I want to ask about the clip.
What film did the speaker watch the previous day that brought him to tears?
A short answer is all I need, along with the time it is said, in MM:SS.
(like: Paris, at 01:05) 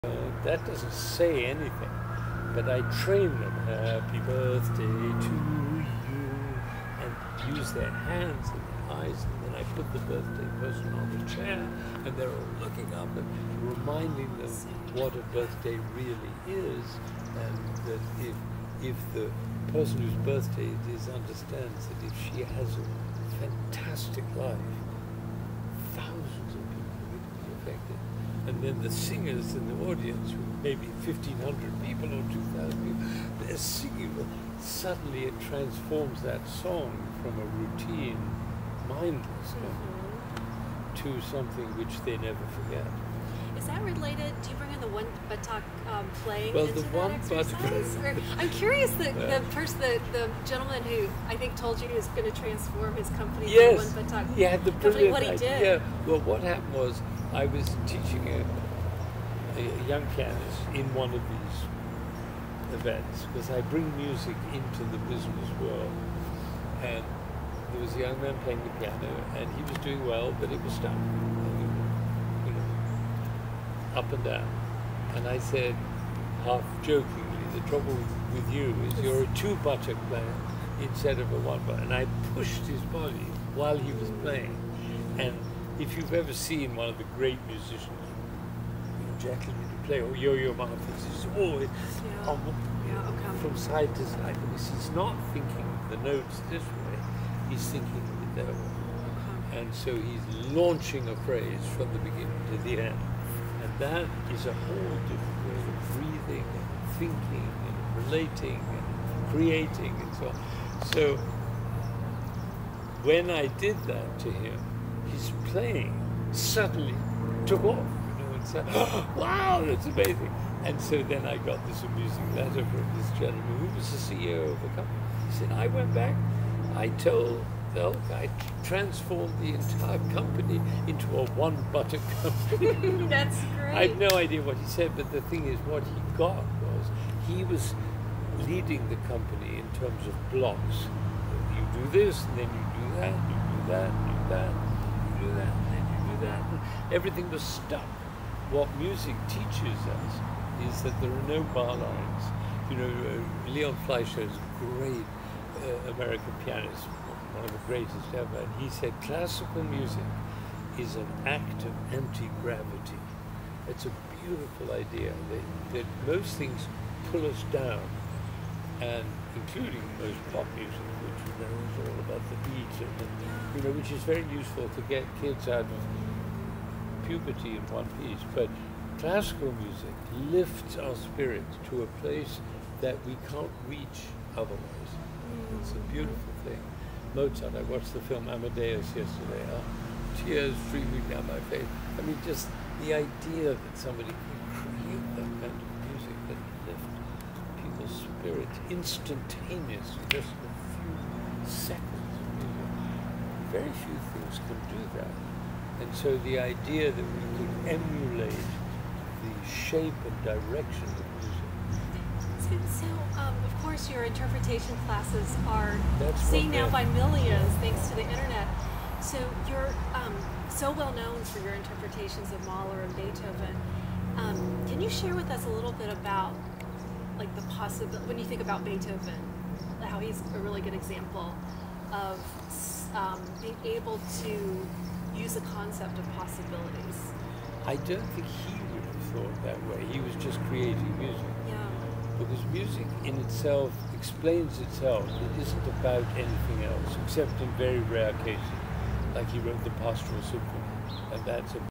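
Amadeus, at 03:08.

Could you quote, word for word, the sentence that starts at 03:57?
I don't think he would have thought that way.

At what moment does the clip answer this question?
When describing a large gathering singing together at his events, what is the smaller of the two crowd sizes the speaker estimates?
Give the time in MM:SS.
00:31.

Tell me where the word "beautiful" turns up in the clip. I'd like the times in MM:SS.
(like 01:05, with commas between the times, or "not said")
02:44, 03:05.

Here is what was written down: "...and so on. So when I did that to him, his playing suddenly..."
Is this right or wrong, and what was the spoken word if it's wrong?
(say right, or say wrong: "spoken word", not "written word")
right.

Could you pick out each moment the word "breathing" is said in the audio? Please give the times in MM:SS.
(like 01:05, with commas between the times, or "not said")
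01:45.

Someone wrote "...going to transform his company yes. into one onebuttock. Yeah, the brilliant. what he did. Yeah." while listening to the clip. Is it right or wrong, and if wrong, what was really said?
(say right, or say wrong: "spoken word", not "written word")
wrong: "buttock", not "onebuttock".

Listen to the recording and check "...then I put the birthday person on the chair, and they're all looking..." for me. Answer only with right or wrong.
right.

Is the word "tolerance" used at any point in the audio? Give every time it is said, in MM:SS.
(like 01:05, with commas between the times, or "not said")
not said.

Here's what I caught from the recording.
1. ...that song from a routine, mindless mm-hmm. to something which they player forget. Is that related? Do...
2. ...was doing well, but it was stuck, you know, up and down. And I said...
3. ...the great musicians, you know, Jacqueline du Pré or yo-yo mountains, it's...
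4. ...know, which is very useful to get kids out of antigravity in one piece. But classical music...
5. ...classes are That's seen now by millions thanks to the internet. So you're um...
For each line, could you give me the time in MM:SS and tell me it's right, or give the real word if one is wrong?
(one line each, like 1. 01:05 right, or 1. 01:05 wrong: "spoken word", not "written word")
1. 00:36 wrong: "never", not "player"
2. 01:09 right
3. 01:26 right
4. 02:53 wrong: "puberty", not "antigravity"
5. 03:34 right.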